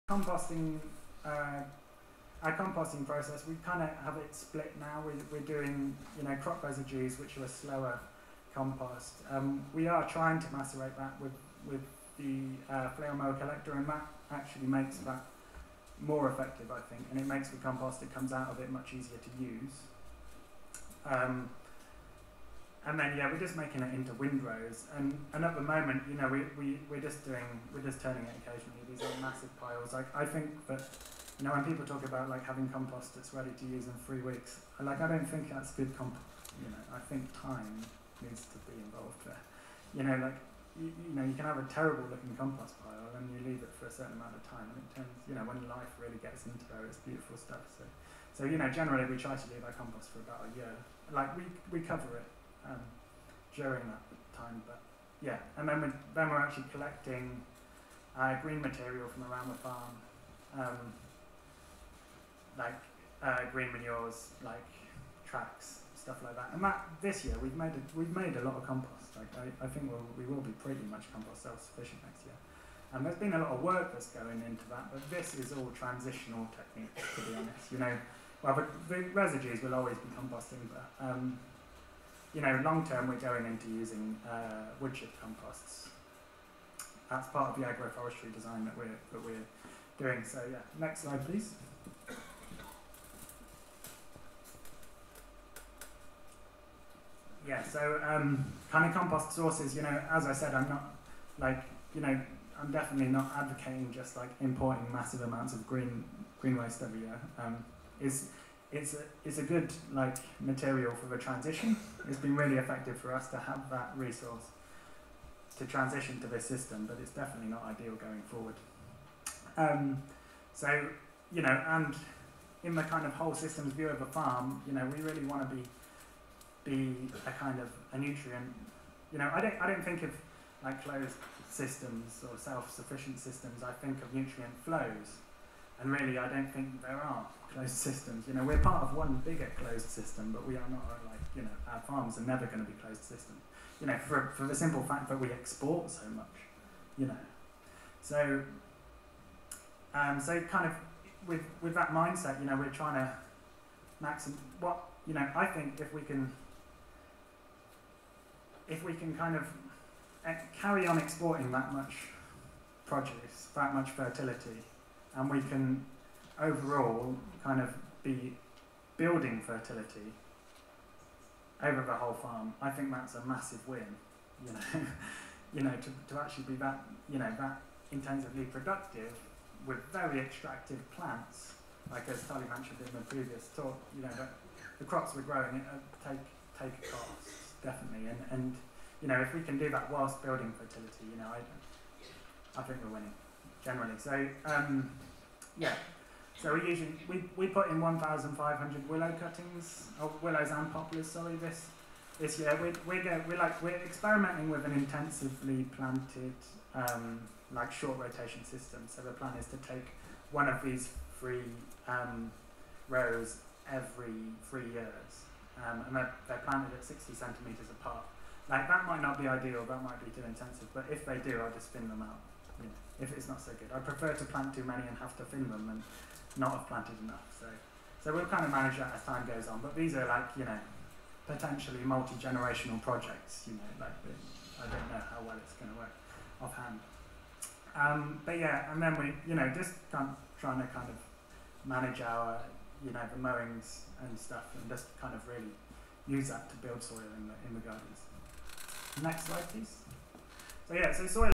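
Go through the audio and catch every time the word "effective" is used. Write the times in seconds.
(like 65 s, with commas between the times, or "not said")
16 s, 112 s.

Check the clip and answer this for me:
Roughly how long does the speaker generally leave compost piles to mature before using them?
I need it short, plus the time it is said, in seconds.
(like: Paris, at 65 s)
about a year, at 50 s.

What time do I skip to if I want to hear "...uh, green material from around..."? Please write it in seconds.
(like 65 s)
58 s.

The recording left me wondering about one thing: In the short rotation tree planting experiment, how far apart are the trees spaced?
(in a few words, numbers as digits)
60 centimeters.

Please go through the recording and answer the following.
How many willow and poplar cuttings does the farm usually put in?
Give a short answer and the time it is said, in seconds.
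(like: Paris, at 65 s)
1,500, at 197 s.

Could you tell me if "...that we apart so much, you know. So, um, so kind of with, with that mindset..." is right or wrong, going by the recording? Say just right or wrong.
wrong.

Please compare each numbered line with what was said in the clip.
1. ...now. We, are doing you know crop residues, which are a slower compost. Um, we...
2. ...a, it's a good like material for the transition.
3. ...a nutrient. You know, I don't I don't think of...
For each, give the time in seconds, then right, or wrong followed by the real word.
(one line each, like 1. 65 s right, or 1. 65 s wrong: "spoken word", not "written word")
1. 4 s right
2. 108 s right
3. 127 s right.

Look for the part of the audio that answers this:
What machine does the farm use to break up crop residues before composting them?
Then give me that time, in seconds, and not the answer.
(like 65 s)
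12 s.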